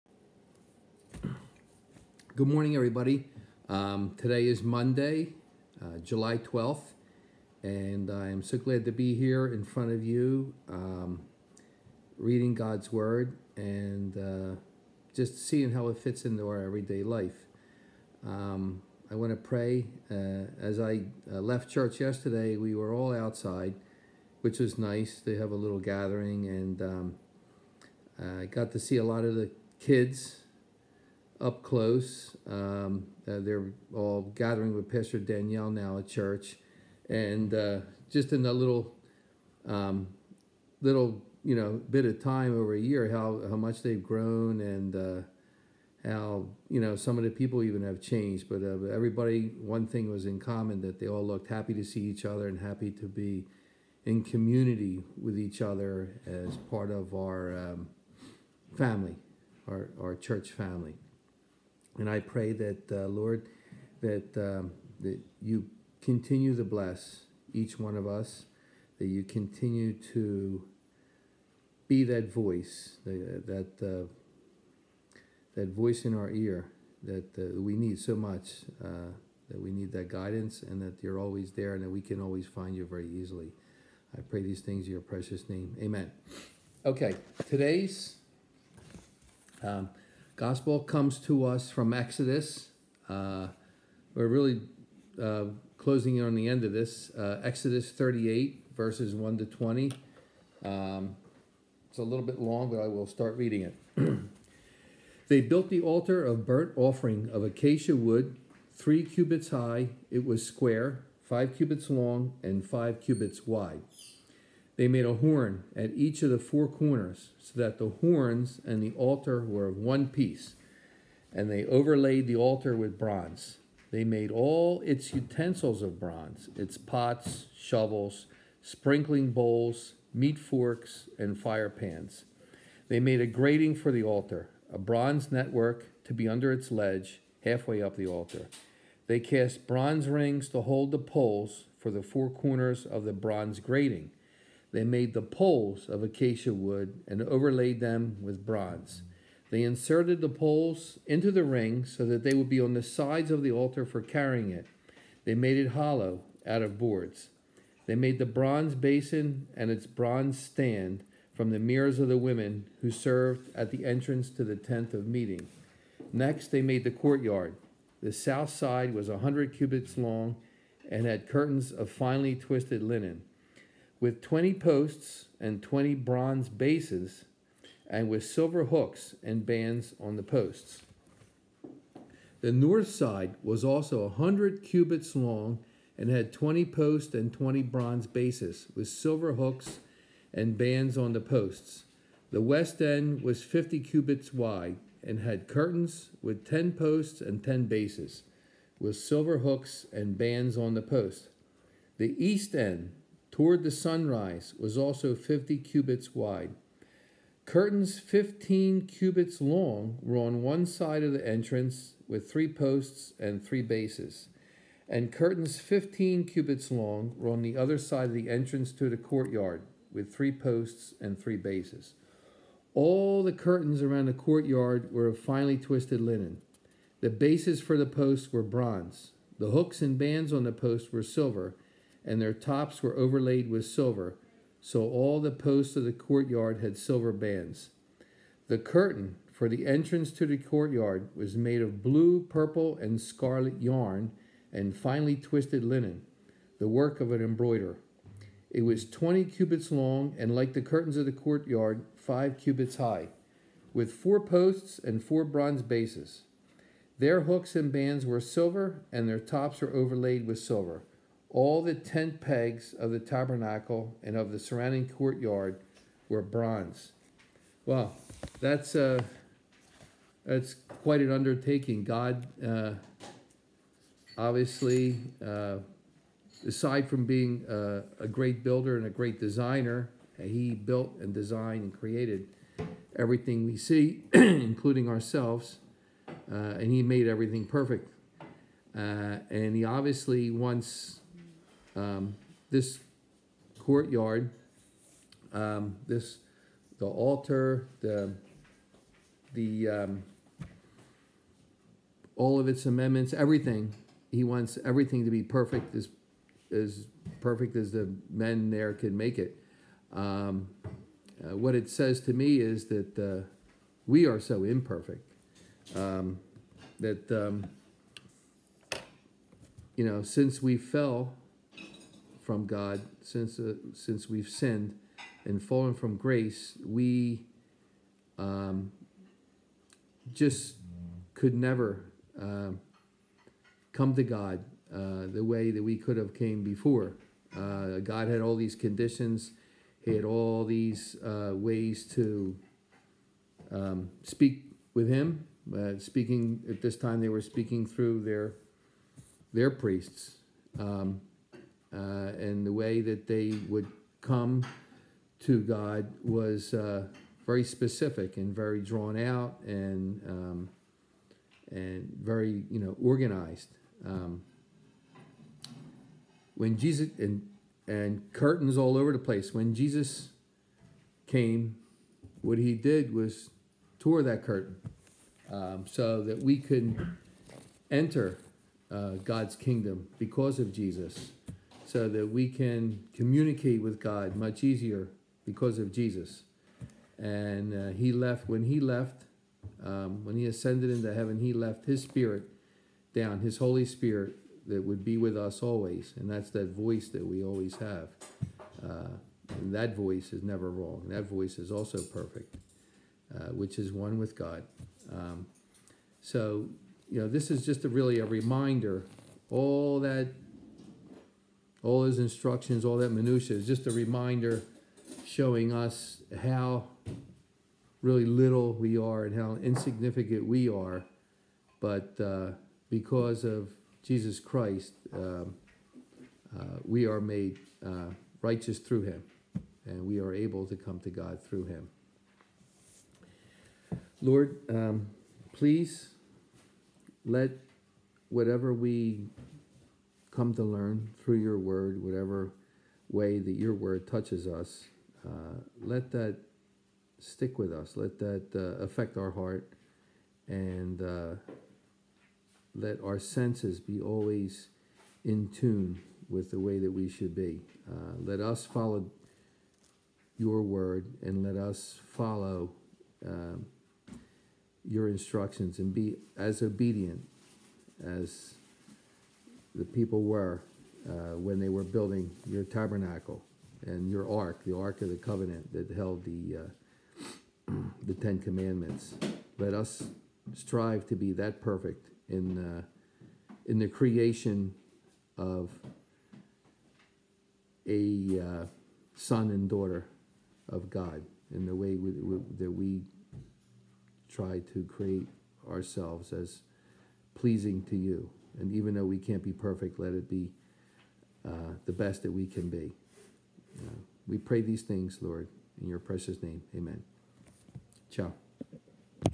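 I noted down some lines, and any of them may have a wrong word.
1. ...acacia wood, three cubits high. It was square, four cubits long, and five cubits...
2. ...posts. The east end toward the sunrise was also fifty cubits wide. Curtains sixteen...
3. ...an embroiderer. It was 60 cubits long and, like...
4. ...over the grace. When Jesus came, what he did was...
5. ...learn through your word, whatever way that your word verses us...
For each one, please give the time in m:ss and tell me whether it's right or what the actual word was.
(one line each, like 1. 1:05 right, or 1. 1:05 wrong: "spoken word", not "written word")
1. 1:47 wrong: "five", not "four"
2. 3:20 wrong: "fifteen", not "sixteen"
3. 4:07 wrong: "20", not "60"
4. 6:08 wrong: "place", not "grace"
5. 7:20 wrong: "touches", not "verses".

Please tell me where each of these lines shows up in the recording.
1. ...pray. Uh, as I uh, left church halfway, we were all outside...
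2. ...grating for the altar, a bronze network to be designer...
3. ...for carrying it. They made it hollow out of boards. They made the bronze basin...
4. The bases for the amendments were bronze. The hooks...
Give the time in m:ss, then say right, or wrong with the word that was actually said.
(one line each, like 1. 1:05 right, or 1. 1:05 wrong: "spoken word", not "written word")
1. 0:19 wrong: "yesterday", not "halfway"
2. 2:13 wrong: "under", not "designer"
3. 2:33 right
4. 3:47 wrong: "posts", not "amendments".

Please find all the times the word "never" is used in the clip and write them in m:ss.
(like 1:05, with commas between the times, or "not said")
5:31, 6:40.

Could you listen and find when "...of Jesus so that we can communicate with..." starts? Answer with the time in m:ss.
6:20.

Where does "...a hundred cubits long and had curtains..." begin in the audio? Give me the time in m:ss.
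2:49.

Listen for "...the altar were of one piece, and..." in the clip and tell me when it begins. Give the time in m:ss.
1:58.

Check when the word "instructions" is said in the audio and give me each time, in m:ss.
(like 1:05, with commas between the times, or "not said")
6:51, 7:44.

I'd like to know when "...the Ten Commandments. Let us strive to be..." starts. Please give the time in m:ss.
7:57.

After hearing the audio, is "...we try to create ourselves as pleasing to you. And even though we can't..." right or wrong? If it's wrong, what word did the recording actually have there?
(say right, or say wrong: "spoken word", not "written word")
right.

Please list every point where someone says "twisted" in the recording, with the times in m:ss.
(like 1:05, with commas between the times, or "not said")
2:52, 3:45, 4:05.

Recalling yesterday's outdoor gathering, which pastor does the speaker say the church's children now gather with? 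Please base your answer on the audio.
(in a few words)
Pastor Danielle.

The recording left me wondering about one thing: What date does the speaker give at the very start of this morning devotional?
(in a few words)
July 12th.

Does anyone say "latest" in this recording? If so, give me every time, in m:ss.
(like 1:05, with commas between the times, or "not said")
not said.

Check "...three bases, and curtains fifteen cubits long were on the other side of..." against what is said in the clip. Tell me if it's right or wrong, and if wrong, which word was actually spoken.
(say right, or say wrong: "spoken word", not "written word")
right.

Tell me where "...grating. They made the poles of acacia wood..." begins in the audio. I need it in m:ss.
2:23.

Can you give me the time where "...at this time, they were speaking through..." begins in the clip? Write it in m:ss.
5:46.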